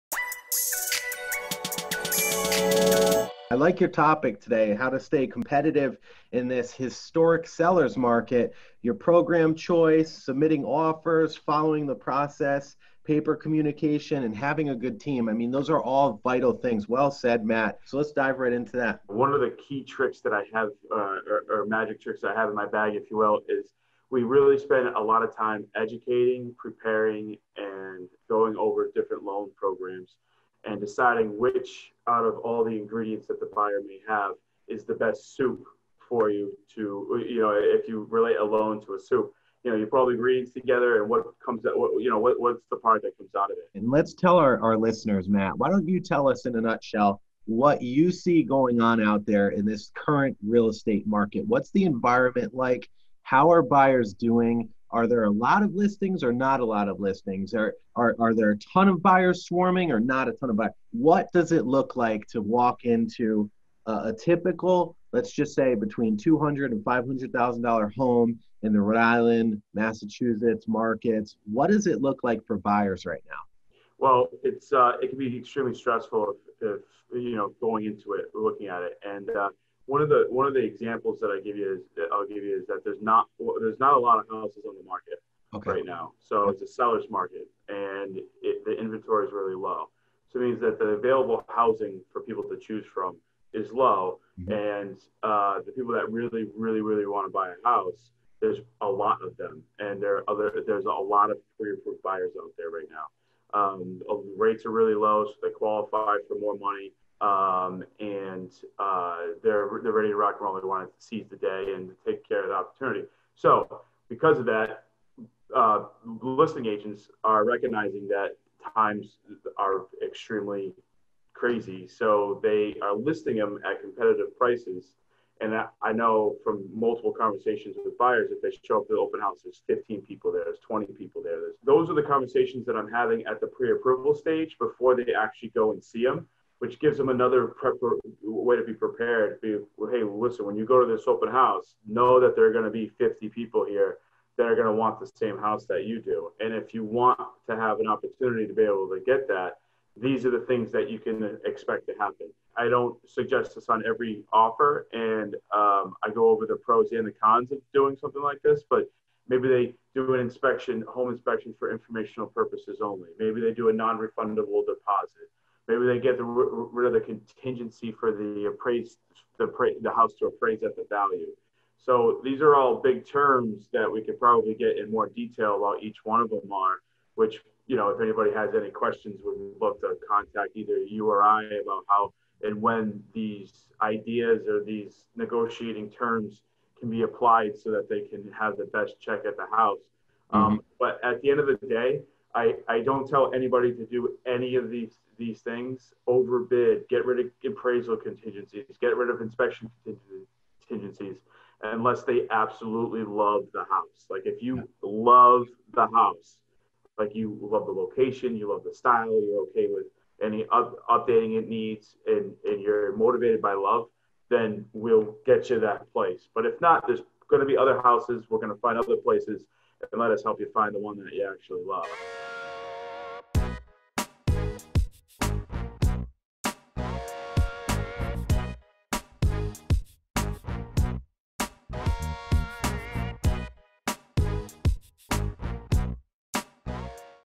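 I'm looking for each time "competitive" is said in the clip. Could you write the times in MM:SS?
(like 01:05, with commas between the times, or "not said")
00:05, 02:03.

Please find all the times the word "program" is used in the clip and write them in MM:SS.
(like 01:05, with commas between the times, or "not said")
00:08, 00:29.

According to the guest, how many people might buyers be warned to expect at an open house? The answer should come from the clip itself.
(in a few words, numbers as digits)
50.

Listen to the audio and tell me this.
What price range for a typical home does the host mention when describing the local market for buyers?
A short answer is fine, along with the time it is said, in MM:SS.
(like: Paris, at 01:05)
$200,000 to $500,000, at 01:06.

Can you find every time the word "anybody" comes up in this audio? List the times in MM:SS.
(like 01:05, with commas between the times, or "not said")
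02:58, 03:13.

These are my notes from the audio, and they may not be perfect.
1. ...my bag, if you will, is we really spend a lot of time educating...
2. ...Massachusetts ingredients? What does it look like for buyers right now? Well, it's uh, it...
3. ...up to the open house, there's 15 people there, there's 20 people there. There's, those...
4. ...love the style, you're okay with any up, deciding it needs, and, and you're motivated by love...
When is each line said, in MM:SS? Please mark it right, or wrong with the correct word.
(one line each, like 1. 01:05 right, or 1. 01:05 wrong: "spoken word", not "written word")
1. 00:22 right
2. 01:09 wrong: "markets", not "ingredients"
3. 02:08 right
4. 03:28 wrong: "updating", not "deciding".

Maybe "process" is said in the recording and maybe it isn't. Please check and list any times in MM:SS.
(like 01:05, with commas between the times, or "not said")
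00:11.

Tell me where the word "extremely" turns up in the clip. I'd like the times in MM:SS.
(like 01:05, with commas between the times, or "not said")
01:15, 02:00.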